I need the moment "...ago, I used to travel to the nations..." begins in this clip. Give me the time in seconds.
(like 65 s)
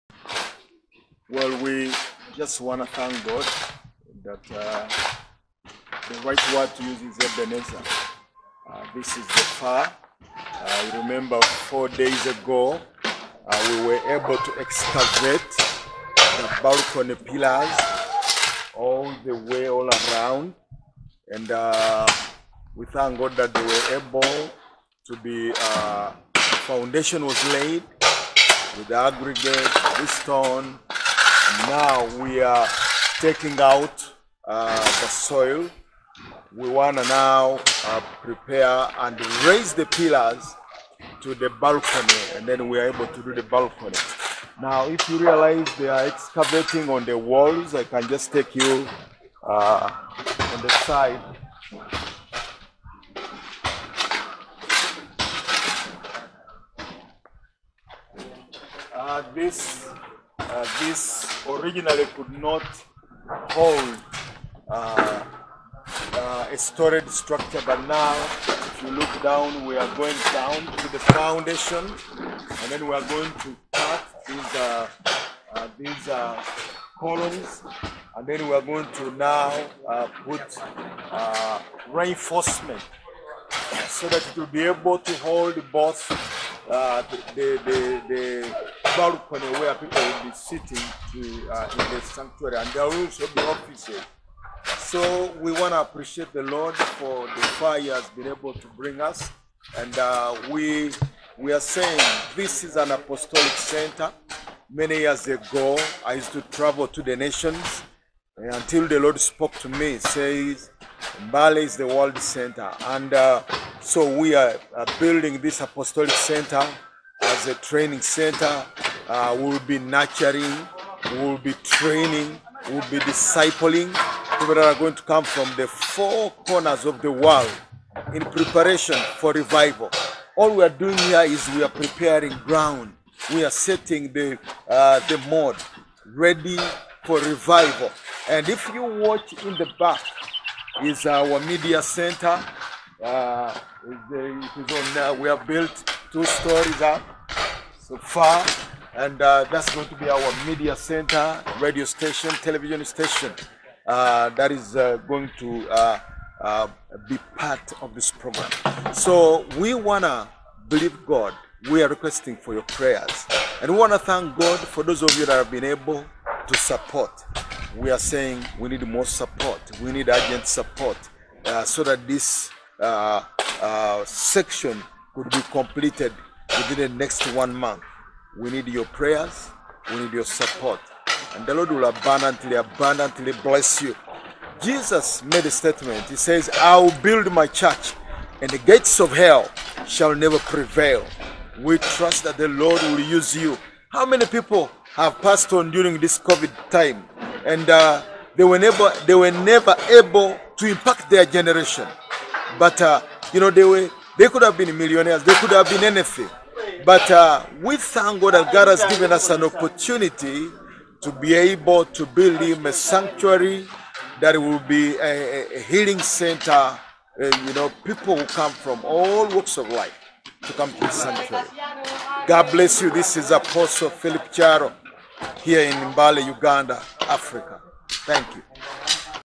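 105 s.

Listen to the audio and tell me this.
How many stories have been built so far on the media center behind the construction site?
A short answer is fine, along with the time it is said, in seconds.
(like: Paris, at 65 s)
2, at 146 s.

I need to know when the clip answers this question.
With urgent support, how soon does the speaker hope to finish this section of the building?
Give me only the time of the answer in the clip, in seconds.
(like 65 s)
177 s.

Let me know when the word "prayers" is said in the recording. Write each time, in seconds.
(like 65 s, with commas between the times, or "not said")
162 s, 178 s.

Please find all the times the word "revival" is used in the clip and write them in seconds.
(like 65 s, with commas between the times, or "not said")
129 s, 137 s.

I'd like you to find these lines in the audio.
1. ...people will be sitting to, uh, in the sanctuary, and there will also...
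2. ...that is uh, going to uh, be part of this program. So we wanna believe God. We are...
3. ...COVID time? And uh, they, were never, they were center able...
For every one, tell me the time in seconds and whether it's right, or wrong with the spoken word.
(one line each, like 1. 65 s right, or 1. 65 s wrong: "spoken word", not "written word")
1. 89 s right
2. 154 s right
3. 196 s wrong: "never", not "center".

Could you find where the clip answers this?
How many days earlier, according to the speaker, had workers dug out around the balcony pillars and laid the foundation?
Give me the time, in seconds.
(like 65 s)
11 s.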